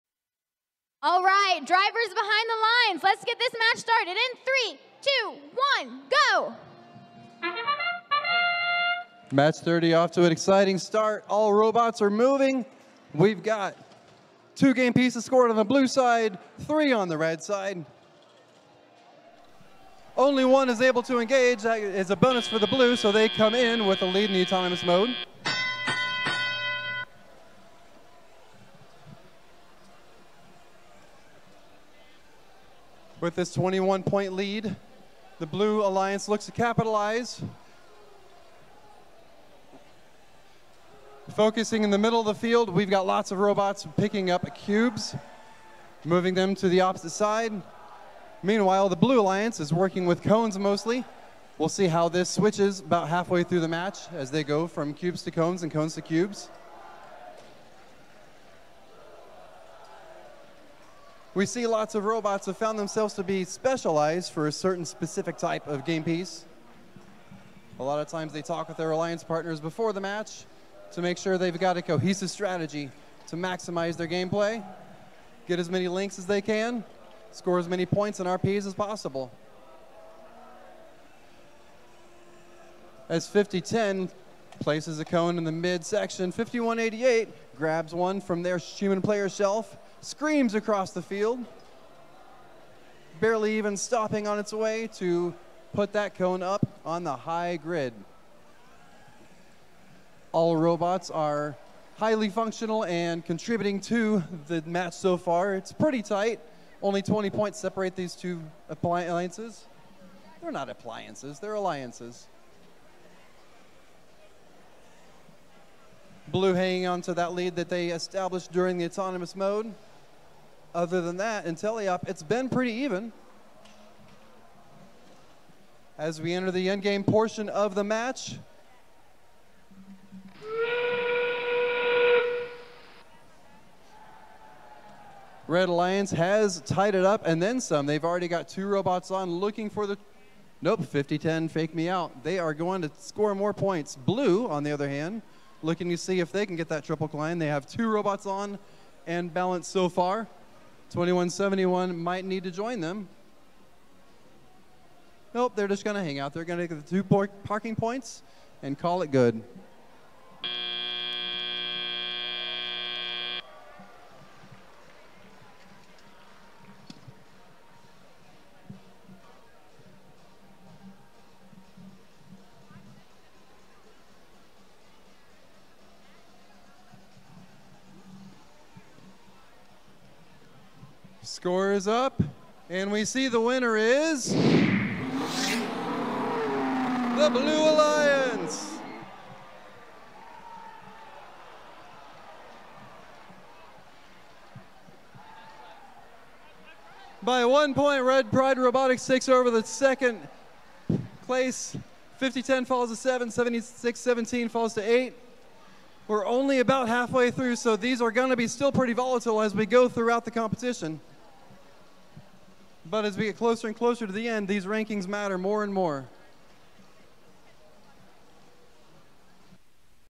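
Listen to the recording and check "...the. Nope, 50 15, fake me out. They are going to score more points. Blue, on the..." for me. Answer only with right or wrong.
wrong.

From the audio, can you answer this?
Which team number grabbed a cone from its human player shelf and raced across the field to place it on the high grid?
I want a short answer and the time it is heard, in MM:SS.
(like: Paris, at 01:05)
5188, at 01:26.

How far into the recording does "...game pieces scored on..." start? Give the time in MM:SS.
00:14.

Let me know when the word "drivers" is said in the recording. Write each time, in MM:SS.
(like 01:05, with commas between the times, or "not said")
00:01.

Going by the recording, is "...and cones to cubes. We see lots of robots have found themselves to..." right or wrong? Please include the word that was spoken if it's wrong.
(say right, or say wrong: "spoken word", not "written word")
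right.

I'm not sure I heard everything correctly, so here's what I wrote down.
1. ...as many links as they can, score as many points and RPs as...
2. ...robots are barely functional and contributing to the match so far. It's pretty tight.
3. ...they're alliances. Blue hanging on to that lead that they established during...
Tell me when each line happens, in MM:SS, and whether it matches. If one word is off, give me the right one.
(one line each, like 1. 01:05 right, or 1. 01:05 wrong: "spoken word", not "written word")
1. 01:15 right
2. 01:40 wrong: "highly", not "barely"
3. 01:51 right.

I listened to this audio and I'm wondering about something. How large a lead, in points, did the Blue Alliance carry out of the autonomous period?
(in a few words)
21.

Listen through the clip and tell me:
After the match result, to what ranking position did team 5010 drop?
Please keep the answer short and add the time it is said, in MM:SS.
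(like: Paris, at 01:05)
7, at 03:22.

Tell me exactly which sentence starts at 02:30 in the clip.
2171 might need to join them.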